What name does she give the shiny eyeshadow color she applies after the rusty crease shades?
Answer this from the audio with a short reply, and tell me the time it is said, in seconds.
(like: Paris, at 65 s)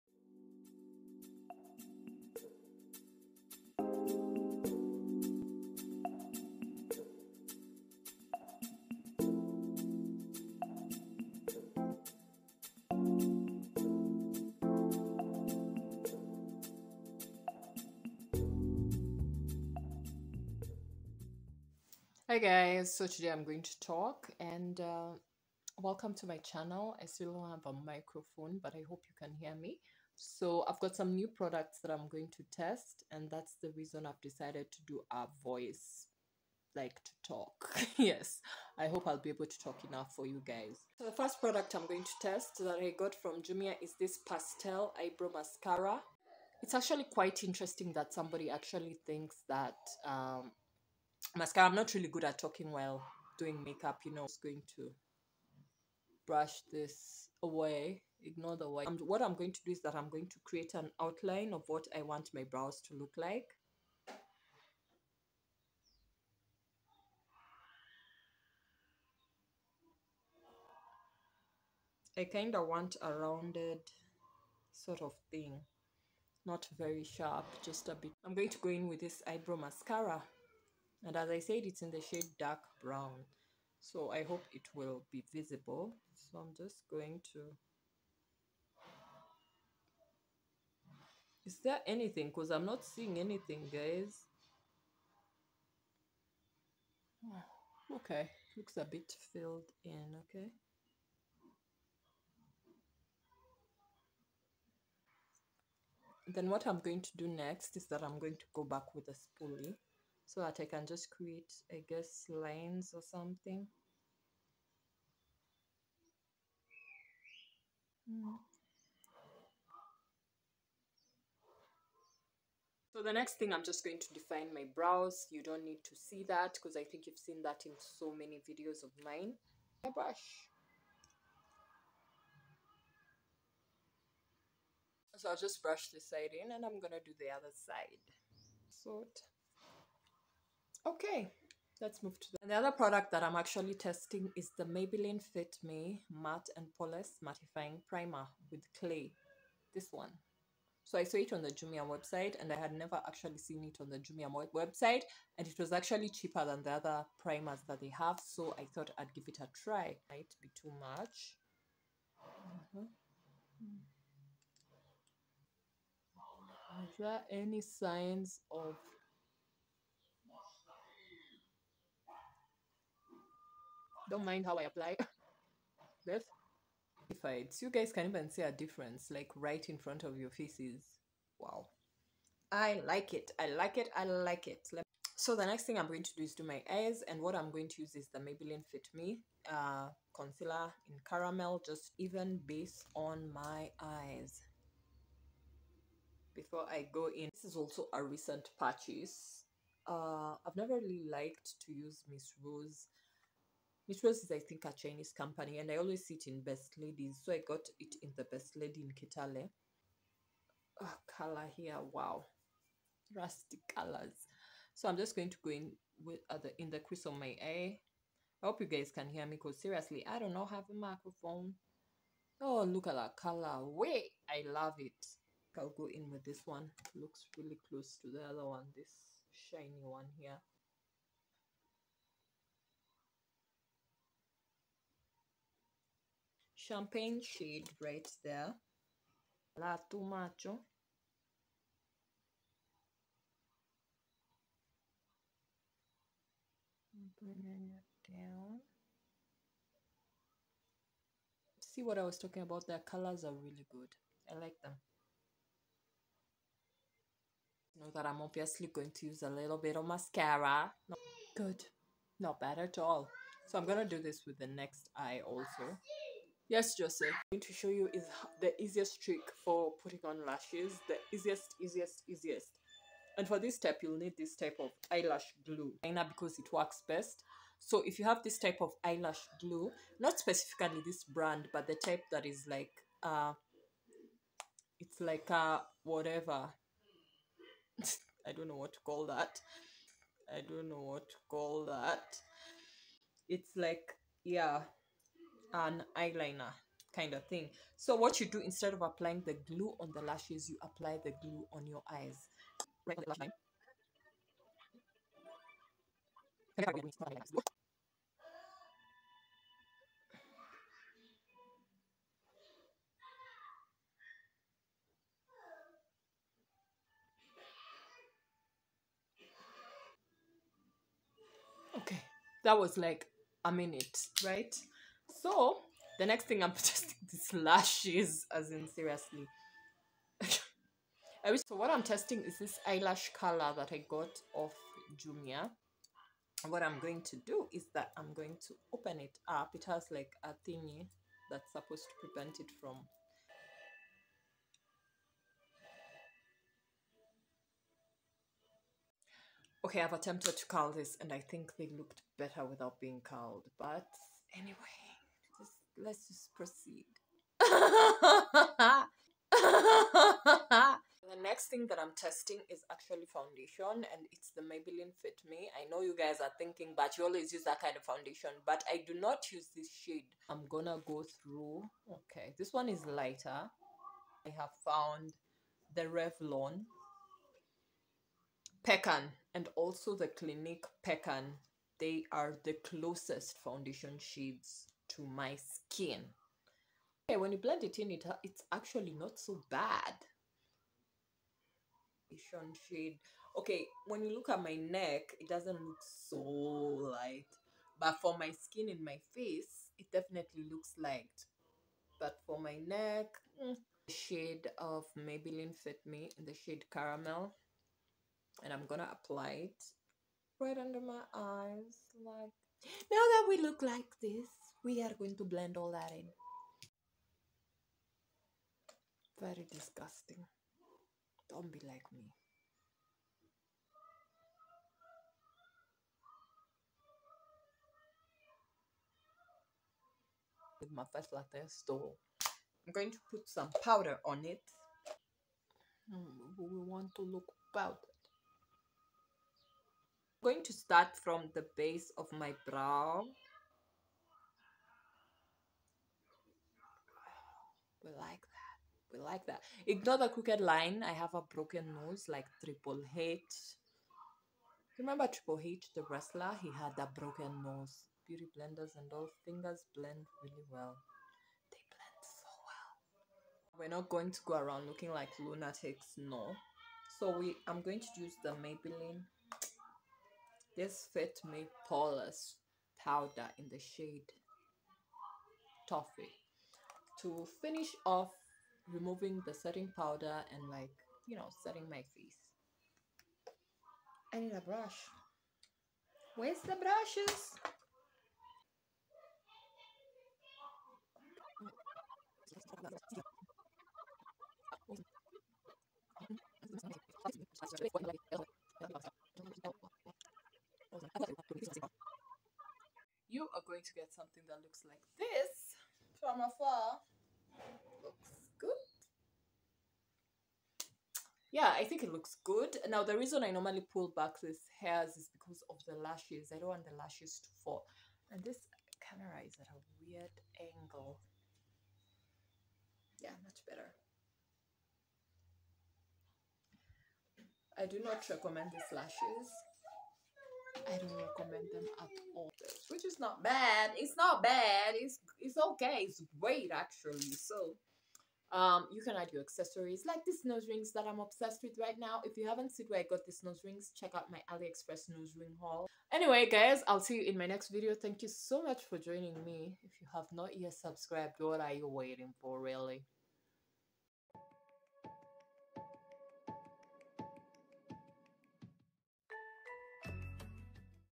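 champagne, at 236 s.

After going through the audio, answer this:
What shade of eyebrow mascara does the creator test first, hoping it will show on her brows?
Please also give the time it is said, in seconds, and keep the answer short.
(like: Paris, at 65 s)
dark brown, at 82 s.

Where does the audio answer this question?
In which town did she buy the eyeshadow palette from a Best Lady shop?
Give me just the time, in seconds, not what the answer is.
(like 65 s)
208 s.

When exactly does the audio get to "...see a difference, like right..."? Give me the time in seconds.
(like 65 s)
178 s.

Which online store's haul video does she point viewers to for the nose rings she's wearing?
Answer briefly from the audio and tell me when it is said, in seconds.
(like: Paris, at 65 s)
AliExpress, at 544 s.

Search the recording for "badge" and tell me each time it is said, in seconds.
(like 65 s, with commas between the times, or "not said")
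not said.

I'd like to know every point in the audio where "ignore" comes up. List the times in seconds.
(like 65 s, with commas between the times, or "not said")
58 s, 449 s.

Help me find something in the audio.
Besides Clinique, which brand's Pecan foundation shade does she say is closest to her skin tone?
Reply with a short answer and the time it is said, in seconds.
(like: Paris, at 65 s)
Revlon, at 375 s.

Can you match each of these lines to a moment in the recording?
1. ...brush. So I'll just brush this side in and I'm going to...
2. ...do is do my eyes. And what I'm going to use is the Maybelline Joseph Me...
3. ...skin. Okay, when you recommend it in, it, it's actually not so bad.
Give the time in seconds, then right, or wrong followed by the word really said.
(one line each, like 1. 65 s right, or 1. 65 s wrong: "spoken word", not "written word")
1. 129 s right
2. 186 s wrong: "Fit", not "Joseph"
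3. 385 s wrong: "blend", not "recommend".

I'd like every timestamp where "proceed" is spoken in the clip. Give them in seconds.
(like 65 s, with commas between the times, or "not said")
356 s.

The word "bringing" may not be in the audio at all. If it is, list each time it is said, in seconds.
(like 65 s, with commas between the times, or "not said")
247 s.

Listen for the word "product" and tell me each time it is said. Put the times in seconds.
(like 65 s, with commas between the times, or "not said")
31 s, 41 s, 142 s.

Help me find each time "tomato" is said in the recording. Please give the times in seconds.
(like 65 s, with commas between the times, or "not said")
239 s.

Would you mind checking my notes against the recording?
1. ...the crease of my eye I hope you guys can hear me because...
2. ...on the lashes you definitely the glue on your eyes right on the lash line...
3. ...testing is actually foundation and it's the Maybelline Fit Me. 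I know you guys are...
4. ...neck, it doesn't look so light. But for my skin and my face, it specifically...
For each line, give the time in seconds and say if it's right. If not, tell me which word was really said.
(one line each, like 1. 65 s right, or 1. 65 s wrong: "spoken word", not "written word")
1. 216 s right
2. 299 s wrong: "apply", not "definitely"
3. 361 s right
4. 394 s wrong: "definitely", not "specifically".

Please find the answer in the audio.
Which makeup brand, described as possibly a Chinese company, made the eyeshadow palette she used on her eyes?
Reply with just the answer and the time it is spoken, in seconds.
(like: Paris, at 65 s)
Miss Rose, at 202 s.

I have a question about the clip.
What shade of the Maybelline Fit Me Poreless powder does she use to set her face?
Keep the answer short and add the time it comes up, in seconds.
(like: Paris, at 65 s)
Toffee, at 475 s.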